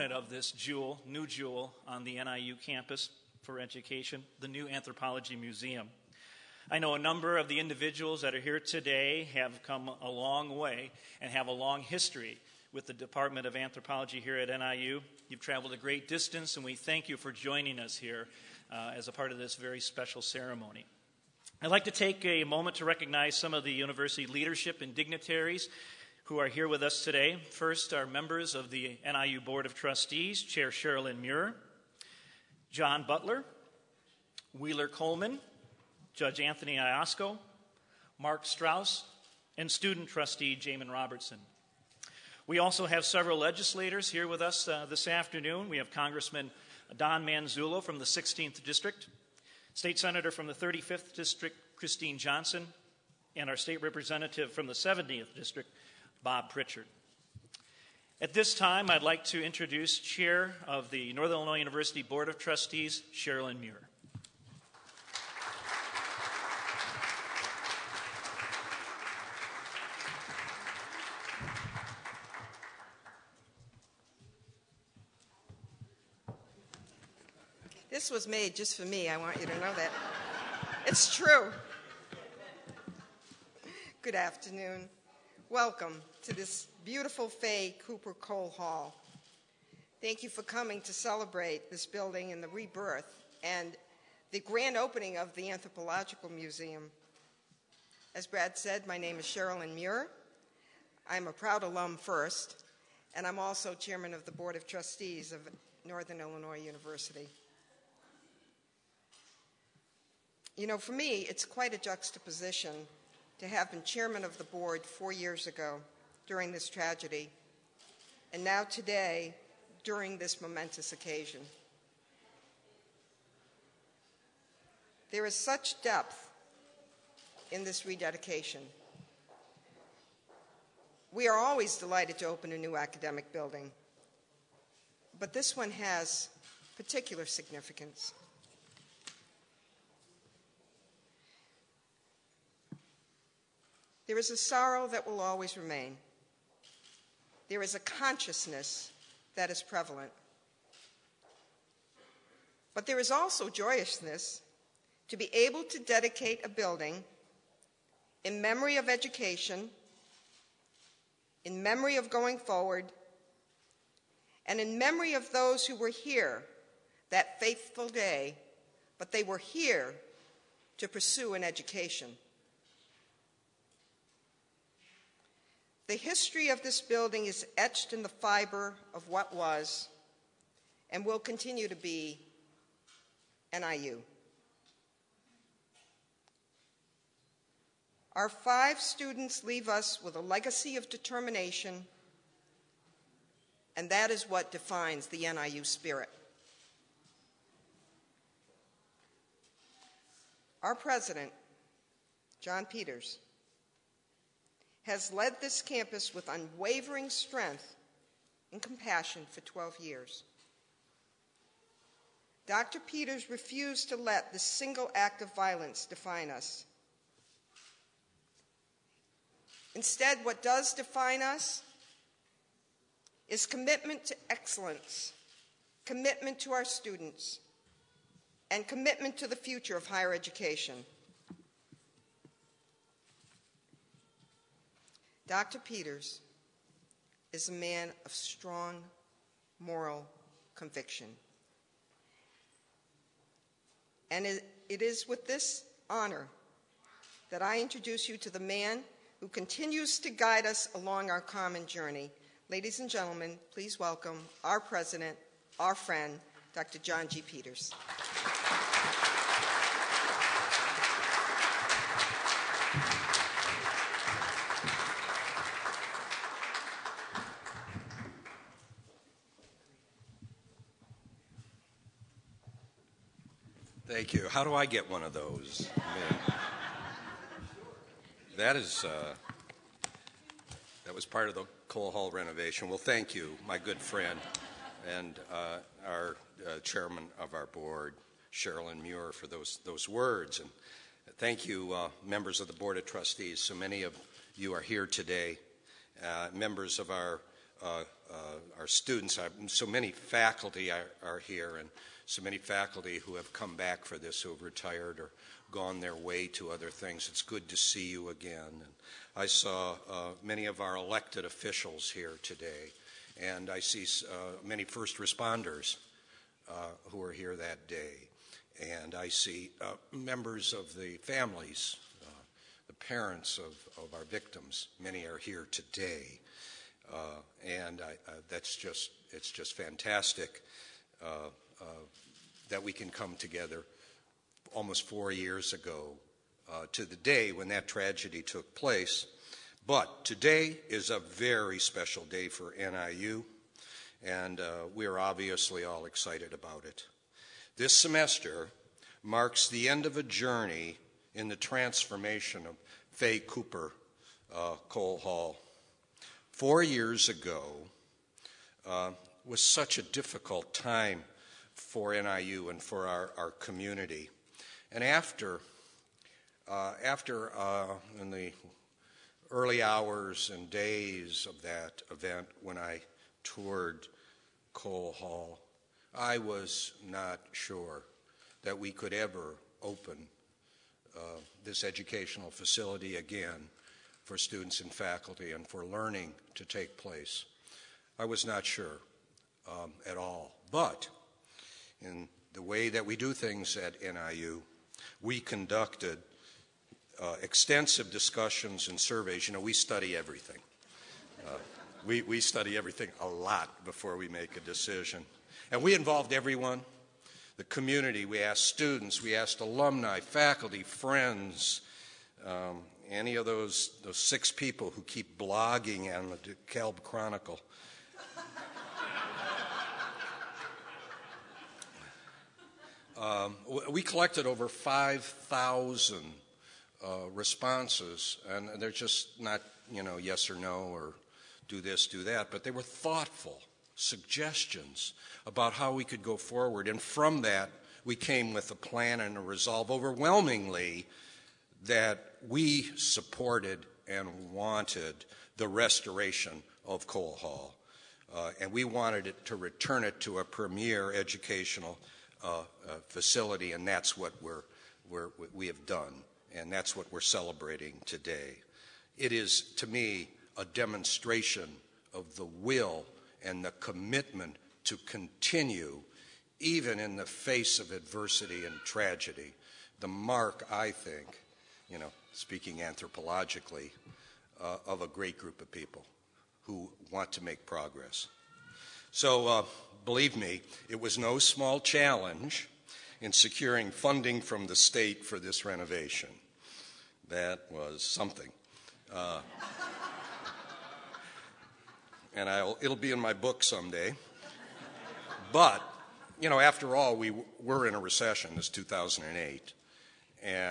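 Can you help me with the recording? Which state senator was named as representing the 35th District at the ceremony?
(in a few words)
Christine Johnson.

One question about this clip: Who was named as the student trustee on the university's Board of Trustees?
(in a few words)
Jamin Robertson.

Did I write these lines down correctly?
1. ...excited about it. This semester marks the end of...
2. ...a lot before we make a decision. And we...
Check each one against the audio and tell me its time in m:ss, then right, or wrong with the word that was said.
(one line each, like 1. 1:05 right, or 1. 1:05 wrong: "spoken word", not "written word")
1. 5:45 right
2. 6:43 right.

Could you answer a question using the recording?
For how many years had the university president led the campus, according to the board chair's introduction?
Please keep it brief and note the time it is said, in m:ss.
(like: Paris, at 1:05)
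12 years, at 3:29.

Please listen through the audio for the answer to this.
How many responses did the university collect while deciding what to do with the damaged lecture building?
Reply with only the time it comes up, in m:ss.
7:04.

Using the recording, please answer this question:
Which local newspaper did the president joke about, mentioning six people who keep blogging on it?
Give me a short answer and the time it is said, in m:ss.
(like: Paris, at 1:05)
DeKalb Chronicle, at 6:56.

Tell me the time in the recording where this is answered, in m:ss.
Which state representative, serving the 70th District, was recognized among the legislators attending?
0:56.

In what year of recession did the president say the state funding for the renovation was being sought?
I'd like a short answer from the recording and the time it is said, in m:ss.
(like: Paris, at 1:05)
2008, at 8:18.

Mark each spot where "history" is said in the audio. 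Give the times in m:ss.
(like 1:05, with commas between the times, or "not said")
0:11, 2:55.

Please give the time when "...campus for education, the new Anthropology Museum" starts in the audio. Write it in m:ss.
0:02.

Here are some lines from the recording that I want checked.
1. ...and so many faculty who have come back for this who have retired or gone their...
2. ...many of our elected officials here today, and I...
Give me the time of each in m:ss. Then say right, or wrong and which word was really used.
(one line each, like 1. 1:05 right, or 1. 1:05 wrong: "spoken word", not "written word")
1. 5:01 right
2. 5:10 right.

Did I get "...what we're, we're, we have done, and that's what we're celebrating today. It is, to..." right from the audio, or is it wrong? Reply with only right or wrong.
right.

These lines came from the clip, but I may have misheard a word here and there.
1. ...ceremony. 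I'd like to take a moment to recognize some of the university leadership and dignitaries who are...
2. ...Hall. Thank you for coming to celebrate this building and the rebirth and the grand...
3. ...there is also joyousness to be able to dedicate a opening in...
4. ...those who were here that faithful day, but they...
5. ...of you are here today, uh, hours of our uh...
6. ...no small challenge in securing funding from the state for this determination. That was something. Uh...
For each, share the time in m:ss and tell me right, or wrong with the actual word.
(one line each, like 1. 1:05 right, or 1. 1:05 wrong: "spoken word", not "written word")
1. 0:20 right
2. 1:28 right
3. 2:32 wrong: "building", not "opening"
4. 2:45 right
5. 4:53 wrong: "members", not "hours"
6. 8:00 wrong: "renovation", not "determination".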